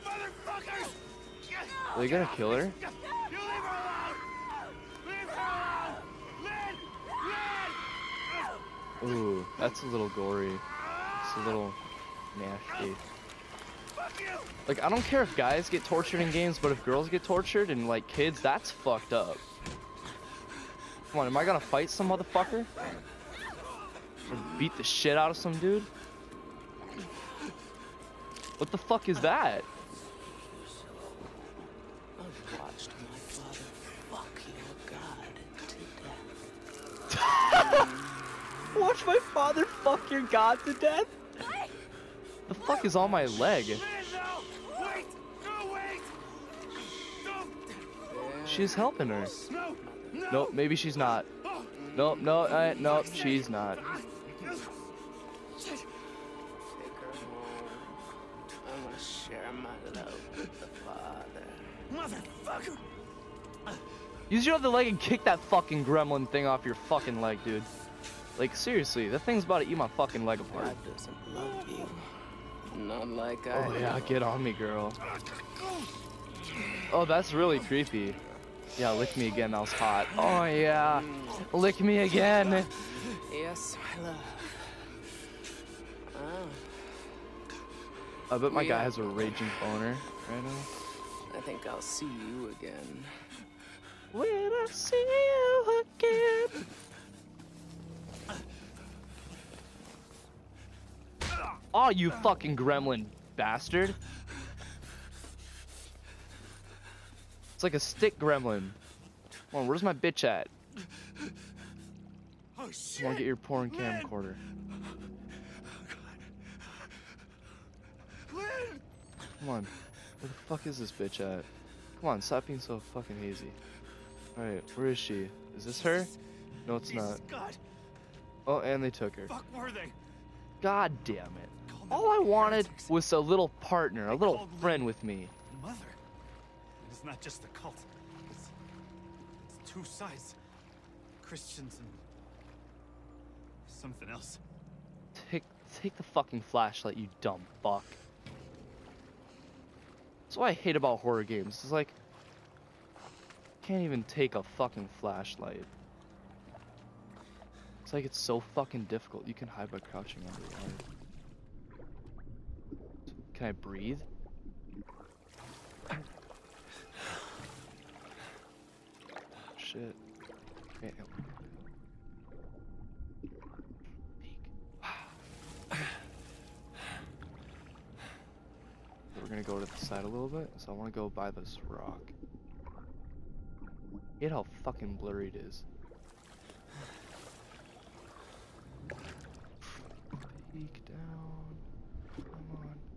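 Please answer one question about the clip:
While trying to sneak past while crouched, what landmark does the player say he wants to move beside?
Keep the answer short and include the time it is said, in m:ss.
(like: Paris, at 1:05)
rock, at 3:01.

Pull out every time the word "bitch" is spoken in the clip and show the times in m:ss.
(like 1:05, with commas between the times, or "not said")
1:49, 2:00.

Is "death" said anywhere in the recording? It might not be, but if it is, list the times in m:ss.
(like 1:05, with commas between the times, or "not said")
0:40.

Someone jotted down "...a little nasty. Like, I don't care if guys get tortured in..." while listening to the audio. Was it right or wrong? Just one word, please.
right.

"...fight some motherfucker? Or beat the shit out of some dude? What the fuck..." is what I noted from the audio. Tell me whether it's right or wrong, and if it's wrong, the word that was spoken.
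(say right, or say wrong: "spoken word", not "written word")
right.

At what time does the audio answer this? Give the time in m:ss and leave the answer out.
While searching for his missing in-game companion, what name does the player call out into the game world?
1:58.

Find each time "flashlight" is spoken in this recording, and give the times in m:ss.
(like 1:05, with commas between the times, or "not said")
2:26, 2:34.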